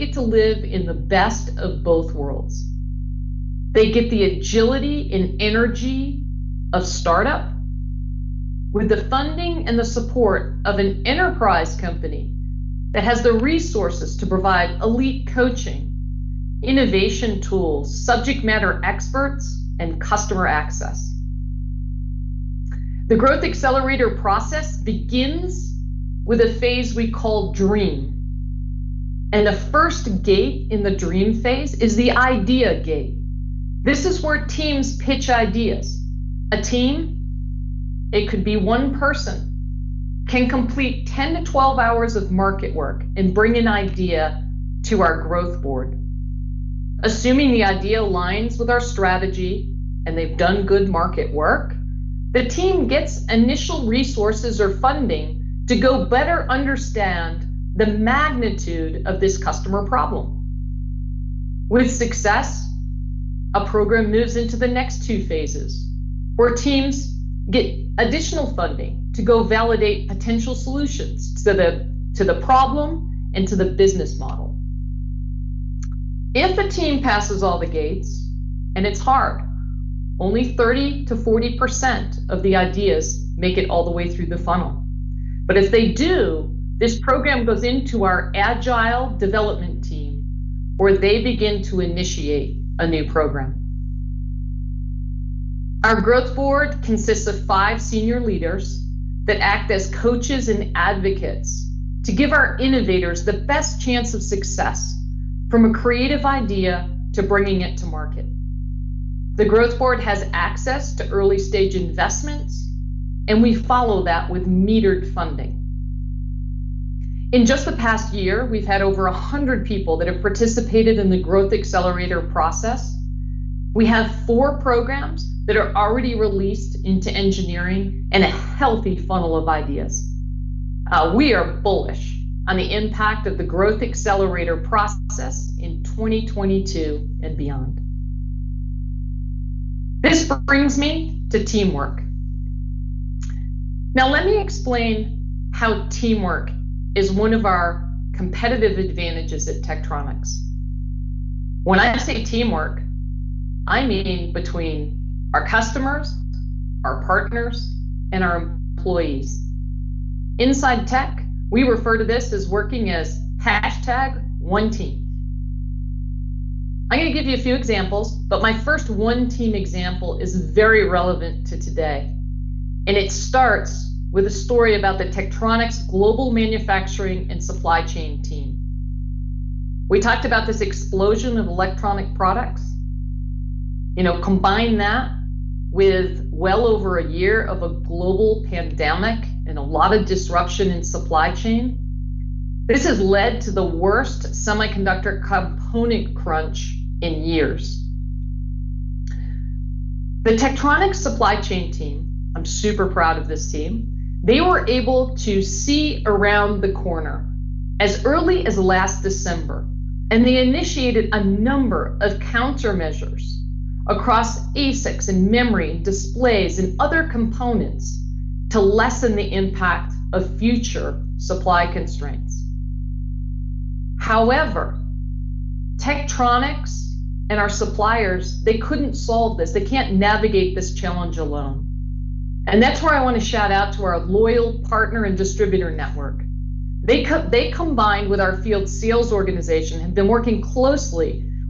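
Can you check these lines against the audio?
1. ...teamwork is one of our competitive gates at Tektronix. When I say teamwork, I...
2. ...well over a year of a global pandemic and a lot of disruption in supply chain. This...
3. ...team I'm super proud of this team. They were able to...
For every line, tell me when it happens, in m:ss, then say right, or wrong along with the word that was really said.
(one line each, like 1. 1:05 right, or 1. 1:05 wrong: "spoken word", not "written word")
1. 2:25 wrong: "advantages", not "gates"
2. 3:06 right
3. 3:21 right.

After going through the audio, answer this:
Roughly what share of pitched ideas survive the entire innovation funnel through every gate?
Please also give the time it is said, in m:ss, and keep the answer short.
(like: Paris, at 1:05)
30 to 40%, at 1:20.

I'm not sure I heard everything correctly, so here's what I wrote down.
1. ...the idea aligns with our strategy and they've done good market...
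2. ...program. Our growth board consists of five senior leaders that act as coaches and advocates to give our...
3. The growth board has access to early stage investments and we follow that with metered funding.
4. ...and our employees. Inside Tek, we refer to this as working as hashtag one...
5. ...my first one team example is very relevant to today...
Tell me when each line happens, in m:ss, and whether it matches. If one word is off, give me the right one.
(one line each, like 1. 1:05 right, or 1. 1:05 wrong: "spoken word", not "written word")
1. 0:47 right
2. 1:33 right
3. 1:49 right
4. 2:38 right
5. 2:48 right.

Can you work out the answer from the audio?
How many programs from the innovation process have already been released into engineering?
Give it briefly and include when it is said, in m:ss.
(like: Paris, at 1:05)
4, at 2:04.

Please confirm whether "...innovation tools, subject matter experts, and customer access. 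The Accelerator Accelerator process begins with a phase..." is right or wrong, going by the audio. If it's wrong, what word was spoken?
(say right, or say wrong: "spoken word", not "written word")
wrong: "Growth", not "Accelerator".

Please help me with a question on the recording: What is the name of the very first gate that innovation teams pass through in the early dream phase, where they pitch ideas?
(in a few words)
idea gate.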